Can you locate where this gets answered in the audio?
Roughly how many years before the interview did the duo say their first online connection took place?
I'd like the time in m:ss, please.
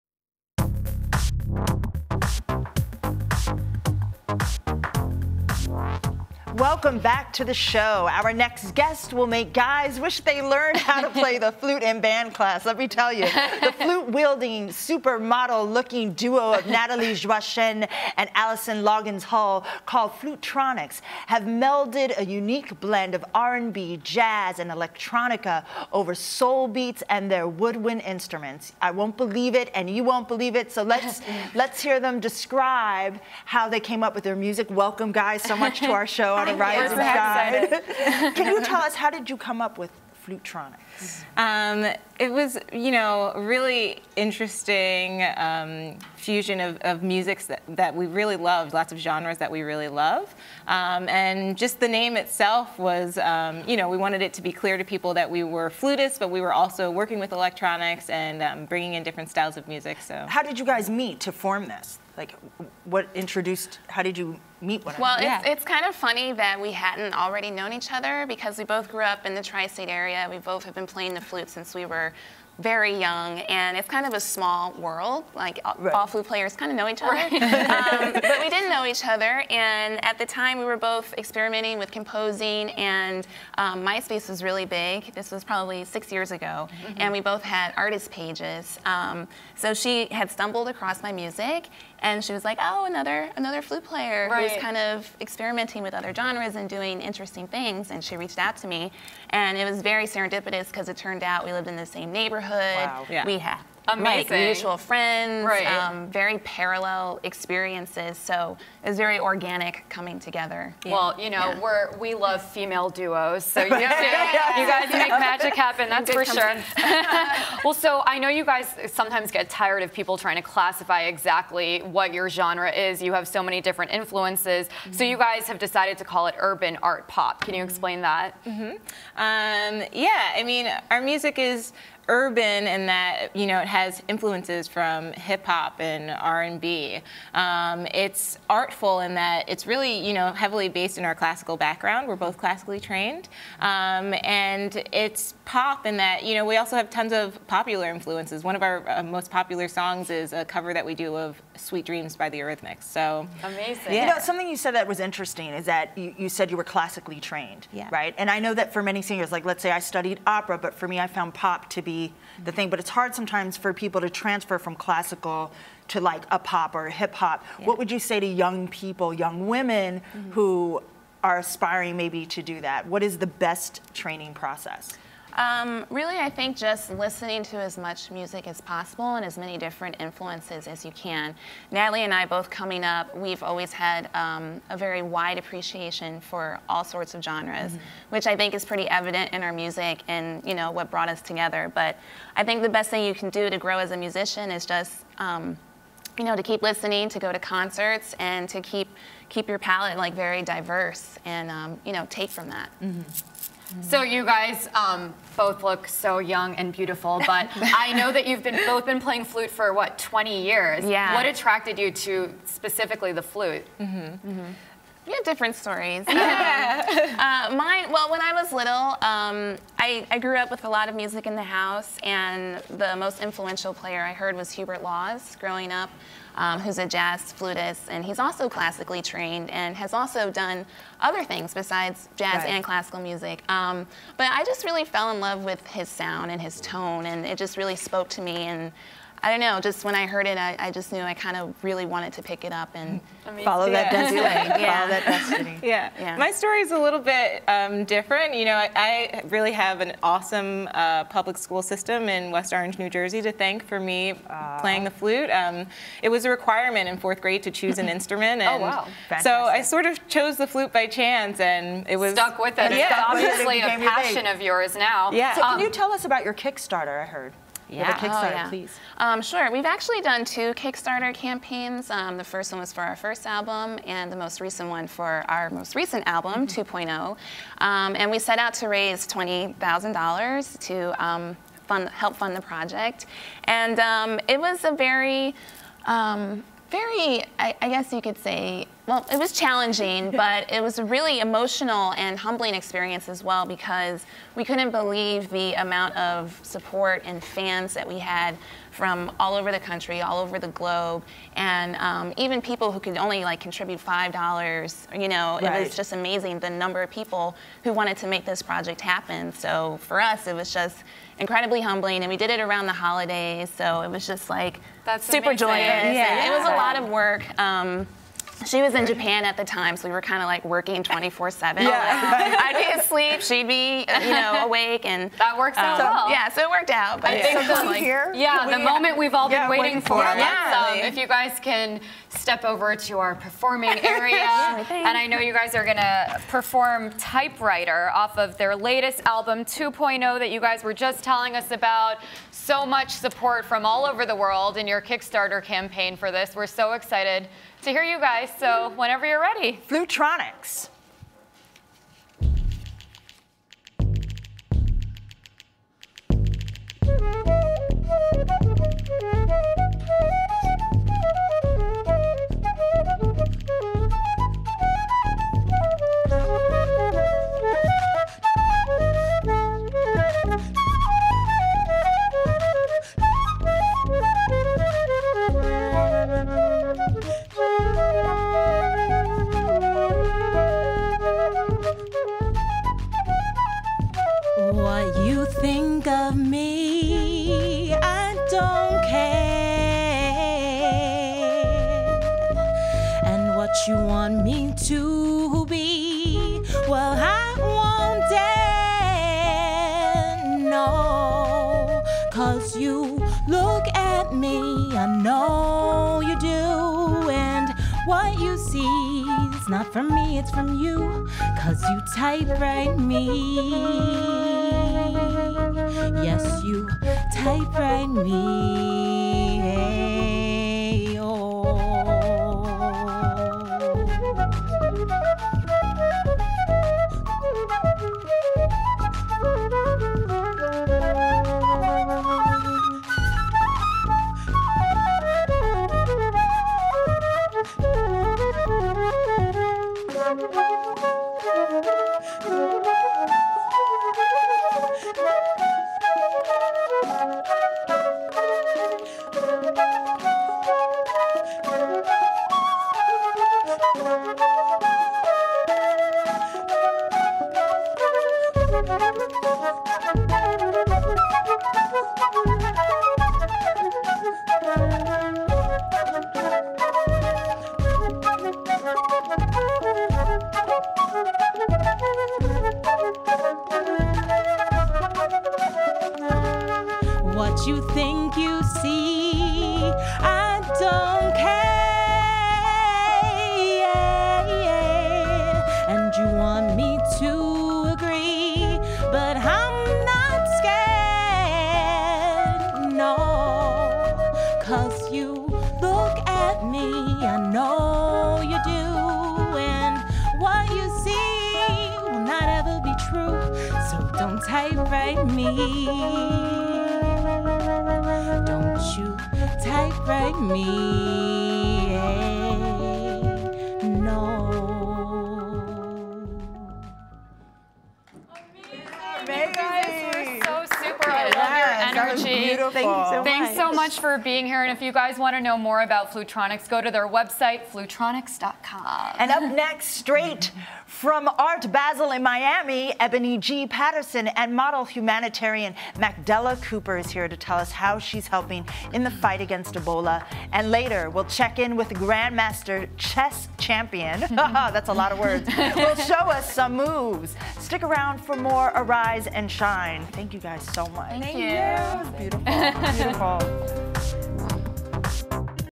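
1:25.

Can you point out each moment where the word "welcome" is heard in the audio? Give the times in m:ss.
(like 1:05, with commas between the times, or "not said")
0:06, 0:34.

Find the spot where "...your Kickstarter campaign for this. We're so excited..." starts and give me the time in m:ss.
5:44.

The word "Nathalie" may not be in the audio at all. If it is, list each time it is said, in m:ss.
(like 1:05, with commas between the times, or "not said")
0:16, 3:01.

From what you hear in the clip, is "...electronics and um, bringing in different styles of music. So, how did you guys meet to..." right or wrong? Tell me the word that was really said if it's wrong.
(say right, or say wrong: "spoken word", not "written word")
right.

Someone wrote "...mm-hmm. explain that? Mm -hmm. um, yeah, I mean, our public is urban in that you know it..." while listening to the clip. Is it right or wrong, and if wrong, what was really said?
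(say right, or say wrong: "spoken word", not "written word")
wrong: "music", not "public".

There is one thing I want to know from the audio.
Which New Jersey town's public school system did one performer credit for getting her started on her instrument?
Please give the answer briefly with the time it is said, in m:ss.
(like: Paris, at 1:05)
West Orange, at 4:12.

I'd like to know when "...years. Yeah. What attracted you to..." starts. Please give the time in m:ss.
3:30.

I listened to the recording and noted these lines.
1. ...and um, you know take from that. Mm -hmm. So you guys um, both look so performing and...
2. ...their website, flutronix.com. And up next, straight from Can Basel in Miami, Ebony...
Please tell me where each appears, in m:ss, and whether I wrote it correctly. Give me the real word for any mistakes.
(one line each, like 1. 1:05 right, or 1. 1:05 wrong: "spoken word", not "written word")
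1. 3:21 wrong: "young", not "performing"
2. 8:46 wrong: "Art", not "Can".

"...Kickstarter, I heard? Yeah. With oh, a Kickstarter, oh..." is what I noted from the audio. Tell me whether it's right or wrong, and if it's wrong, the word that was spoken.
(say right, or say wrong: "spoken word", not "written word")
right.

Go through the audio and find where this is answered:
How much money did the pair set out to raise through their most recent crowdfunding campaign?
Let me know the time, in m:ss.
4:39.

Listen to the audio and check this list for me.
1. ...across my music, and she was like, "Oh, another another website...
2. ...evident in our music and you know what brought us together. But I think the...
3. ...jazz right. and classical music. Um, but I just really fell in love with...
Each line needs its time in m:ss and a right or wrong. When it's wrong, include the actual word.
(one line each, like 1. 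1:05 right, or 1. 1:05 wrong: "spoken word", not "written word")
1. 1:30 wrong: "flute", not "website"
2. 3:08 right
3. 3:52 right.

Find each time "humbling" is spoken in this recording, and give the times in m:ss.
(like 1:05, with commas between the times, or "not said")
4:52, 5:11.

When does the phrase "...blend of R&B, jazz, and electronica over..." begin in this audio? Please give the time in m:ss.
0:22.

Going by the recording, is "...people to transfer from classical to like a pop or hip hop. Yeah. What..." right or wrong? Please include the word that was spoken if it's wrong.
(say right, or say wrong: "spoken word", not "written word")
right.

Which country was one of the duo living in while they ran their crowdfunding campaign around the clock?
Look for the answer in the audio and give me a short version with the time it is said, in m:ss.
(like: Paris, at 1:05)
Japan, at 5:18.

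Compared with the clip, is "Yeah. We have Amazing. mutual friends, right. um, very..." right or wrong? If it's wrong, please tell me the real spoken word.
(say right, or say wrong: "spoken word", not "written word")
right.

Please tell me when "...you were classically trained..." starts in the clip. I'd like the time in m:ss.
2:36.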